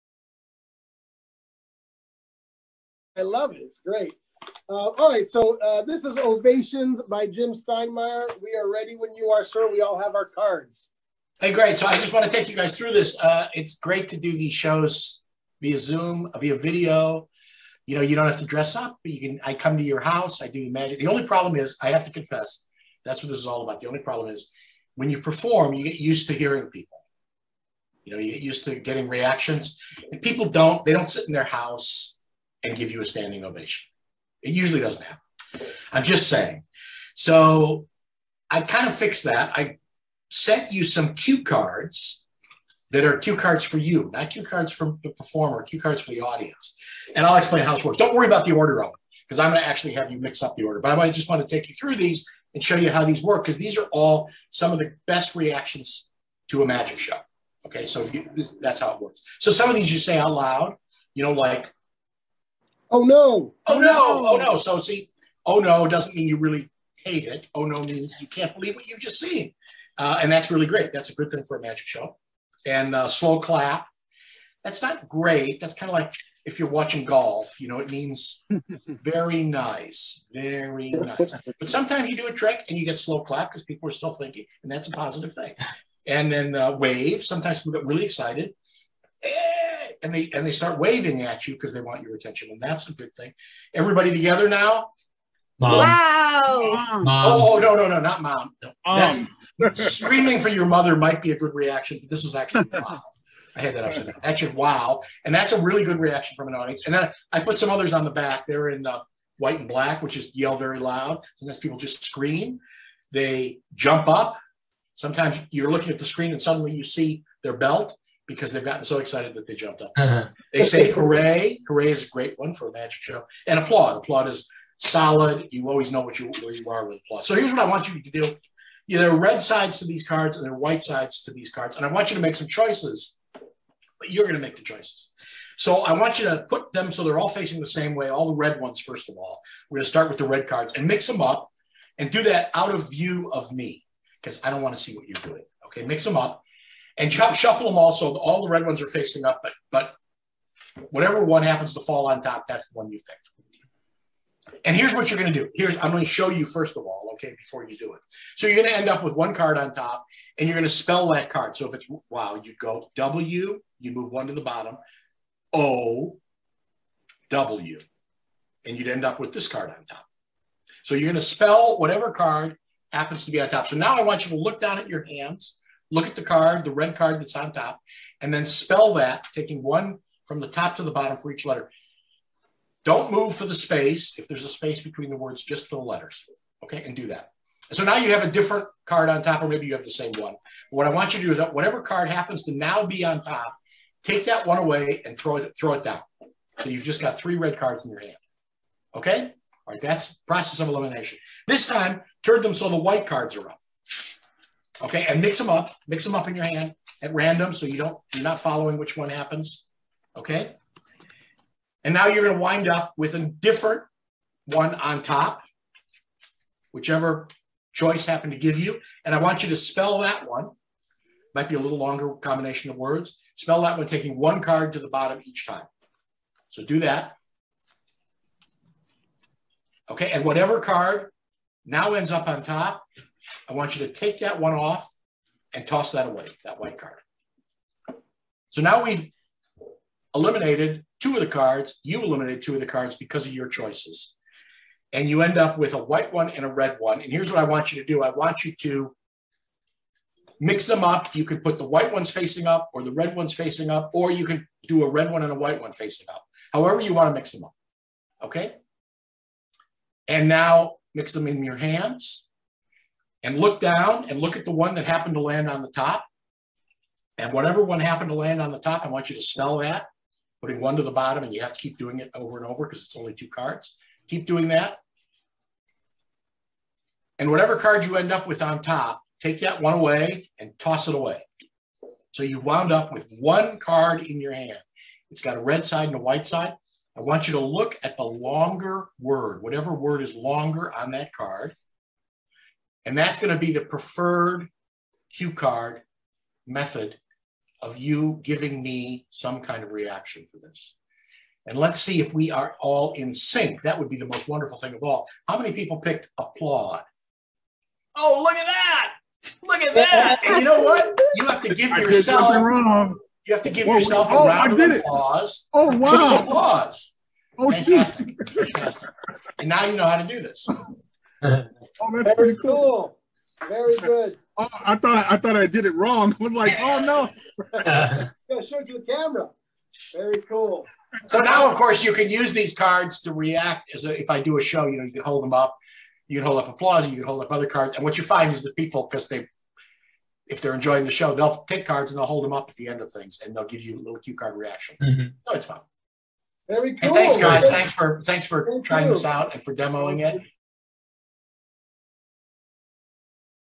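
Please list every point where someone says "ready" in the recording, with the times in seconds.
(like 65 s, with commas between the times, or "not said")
8 s.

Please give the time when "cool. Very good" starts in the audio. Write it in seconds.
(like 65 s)
323 s.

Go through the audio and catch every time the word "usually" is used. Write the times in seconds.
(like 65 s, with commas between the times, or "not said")
34 s.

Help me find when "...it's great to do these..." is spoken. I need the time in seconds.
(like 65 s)
13 s.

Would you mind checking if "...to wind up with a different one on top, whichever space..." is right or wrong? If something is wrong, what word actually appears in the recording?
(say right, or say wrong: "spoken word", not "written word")
wrong: "choice", not "space".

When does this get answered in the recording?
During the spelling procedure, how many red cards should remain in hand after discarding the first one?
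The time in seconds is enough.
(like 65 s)
197 s.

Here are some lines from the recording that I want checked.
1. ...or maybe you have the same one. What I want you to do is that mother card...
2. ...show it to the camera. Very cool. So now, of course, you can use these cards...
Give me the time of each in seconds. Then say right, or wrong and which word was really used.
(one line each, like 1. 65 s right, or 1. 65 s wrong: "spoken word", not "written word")
1. 189 s wrong: "whatever", not "mother"
2. 328 s right.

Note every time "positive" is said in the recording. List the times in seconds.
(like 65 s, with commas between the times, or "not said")
84 s.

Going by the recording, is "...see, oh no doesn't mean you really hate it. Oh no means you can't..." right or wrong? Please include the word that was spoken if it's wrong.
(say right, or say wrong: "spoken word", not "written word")
right.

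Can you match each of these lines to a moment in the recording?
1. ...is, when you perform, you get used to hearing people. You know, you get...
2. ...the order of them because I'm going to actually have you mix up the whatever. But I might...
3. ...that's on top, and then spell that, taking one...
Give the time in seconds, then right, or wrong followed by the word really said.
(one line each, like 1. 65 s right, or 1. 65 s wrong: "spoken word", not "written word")
1. 24 s right
2. 48 s wrong: "order", not "whatever"
3. 177 s right.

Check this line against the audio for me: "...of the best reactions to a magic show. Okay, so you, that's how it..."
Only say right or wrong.
right.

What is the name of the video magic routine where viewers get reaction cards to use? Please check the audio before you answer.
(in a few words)
Ovations.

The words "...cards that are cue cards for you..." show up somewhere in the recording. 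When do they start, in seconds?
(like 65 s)
41 s.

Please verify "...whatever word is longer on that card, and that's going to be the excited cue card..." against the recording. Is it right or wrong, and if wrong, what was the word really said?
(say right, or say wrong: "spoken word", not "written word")
wrong: "preferred", not "excited".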